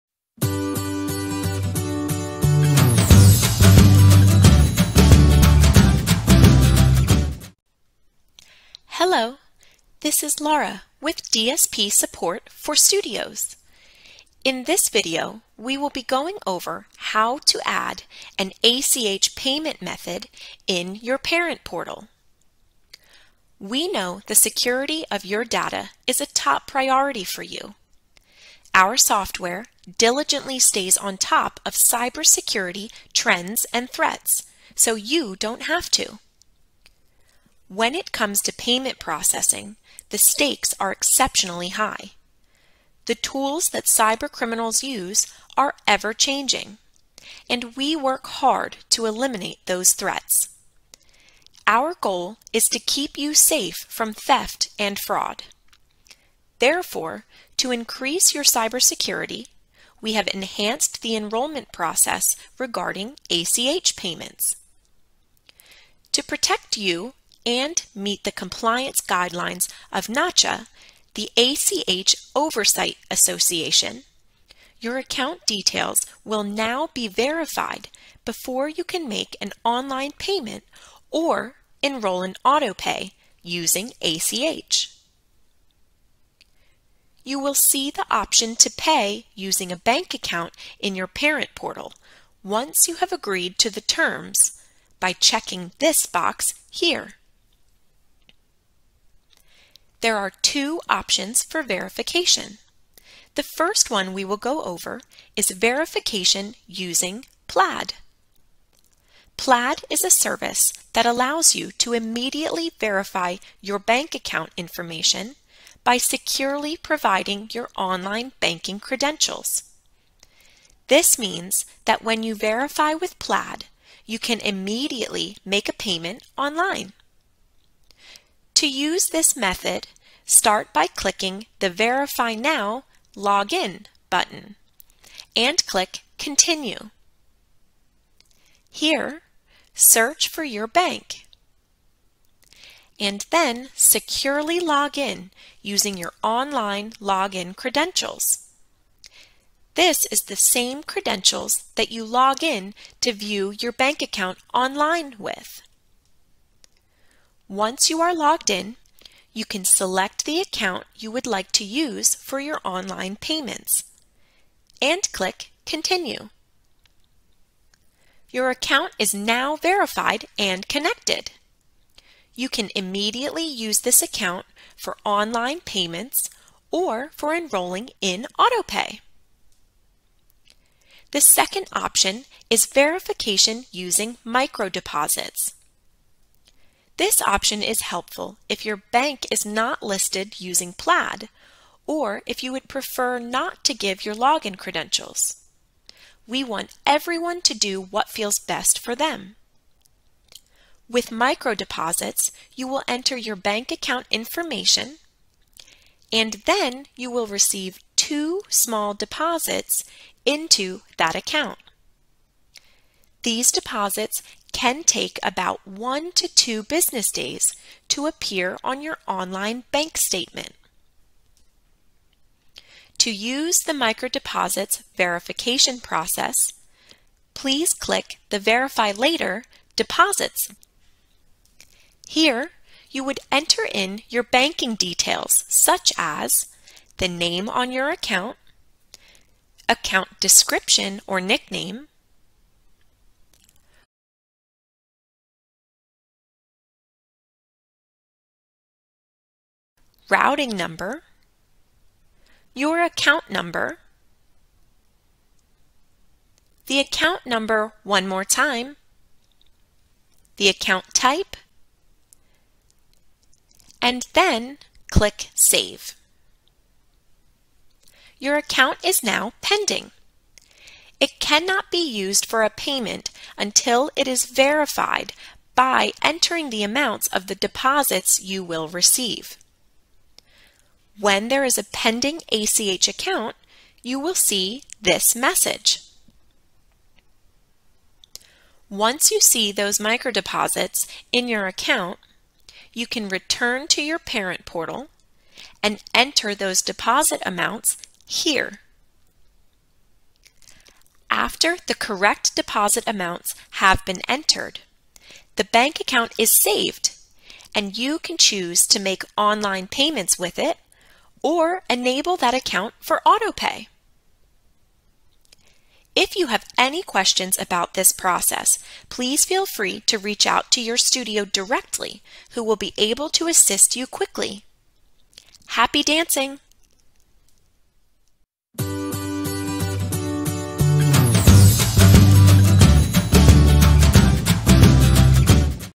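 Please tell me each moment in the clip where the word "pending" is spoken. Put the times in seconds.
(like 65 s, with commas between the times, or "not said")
269 s, 281 s.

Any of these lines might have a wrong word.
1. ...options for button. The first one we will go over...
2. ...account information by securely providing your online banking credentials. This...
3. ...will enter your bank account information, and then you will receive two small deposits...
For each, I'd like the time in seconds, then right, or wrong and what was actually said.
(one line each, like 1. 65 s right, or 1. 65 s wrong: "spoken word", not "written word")
1. 100 s wrong: "verification", not "button"
2. 114 s right
3. 202 s right.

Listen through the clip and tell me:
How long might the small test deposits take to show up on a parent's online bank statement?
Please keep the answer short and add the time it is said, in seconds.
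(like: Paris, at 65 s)
1 to 2 business days, at 215 s.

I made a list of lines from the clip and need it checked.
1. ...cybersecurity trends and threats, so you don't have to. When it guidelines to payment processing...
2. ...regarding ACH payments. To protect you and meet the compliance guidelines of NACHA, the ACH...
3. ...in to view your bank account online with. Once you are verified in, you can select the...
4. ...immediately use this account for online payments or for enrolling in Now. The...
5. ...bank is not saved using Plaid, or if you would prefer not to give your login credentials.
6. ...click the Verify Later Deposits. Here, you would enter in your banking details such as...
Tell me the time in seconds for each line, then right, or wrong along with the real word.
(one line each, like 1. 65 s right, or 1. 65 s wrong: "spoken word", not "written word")
1. 31 s wrong: "comes", not "guidelines"
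2. 62 s right
3. 152 s wrong: "logged", not "verified"
4. 172 s wrong: "AutoPay", not "Now"
5. 188 s wrong: "listed", not "saved"
6. 227 s right.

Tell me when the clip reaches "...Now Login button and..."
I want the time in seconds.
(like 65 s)
132 s.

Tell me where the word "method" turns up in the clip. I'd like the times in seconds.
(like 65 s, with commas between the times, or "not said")
19 s, 129 s.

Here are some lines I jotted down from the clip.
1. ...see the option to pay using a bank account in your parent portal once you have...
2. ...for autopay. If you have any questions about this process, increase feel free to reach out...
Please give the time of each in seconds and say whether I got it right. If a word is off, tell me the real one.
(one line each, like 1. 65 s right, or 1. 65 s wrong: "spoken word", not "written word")
1. 87 s right
2. 312 s wrong: "please", not "increase".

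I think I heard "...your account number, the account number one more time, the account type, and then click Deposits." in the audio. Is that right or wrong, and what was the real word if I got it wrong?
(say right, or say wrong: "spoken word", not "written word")
wrong: "Save", not "Deposits".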